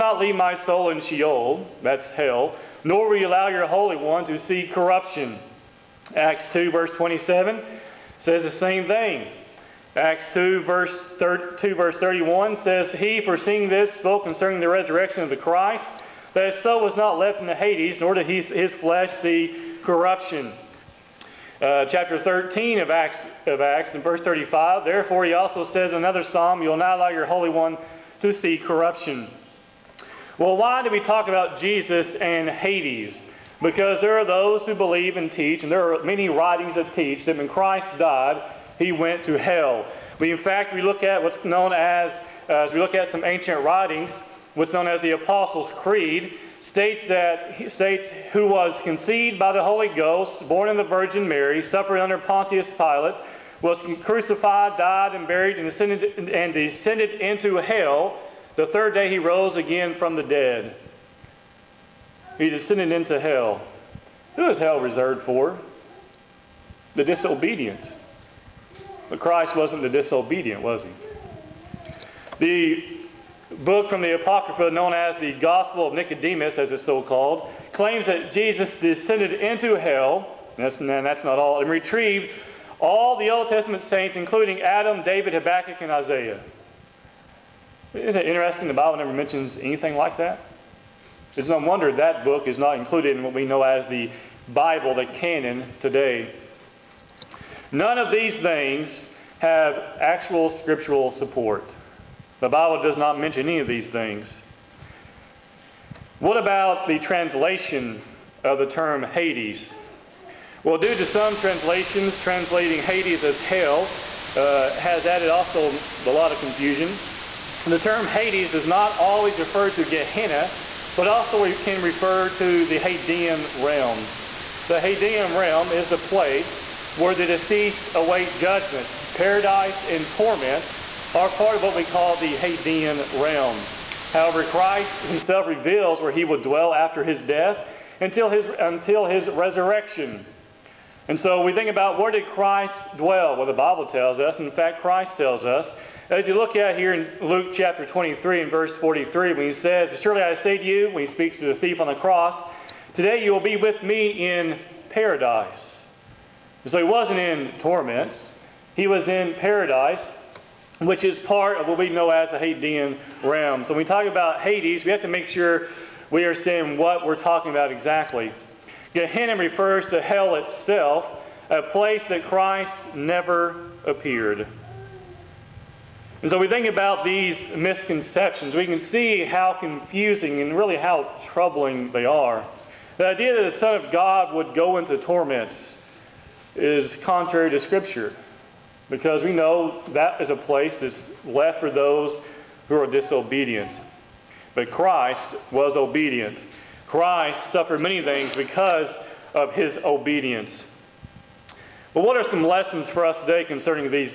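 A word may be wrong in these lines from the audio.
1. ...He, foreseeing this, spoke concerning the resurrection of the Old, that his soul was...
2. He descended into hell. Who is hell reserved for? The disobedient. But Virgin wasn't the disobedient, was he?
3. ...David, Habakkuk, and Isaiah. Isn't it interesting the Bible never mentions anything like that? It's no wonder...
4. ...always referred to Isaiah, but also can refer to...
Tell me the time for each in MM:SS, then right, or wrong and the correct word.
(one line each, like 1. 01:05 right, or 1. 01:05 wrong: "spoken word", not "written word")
1. 00:12 wrong: "Christ", not "Old"
2. 01:02 wrong: "Christ", not "Virgin"
3. 01:25 right
4. 01:58 wrong: "Gehenna", not "Isaiah".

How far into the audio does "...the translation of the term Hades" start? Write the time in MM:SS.
01:46.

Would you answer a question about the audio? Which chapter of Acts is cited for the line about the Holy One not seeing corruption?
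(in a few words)
Chapter 13.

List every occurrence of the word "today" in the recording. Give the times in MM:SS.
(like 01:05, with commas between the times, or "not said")
01:35, 02:32, 03:23.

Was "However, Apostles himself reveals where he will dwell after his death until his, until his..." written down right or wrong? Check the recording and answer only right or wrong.
wrong.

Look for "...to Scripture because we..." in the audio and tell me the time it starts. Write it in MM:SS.
03:07.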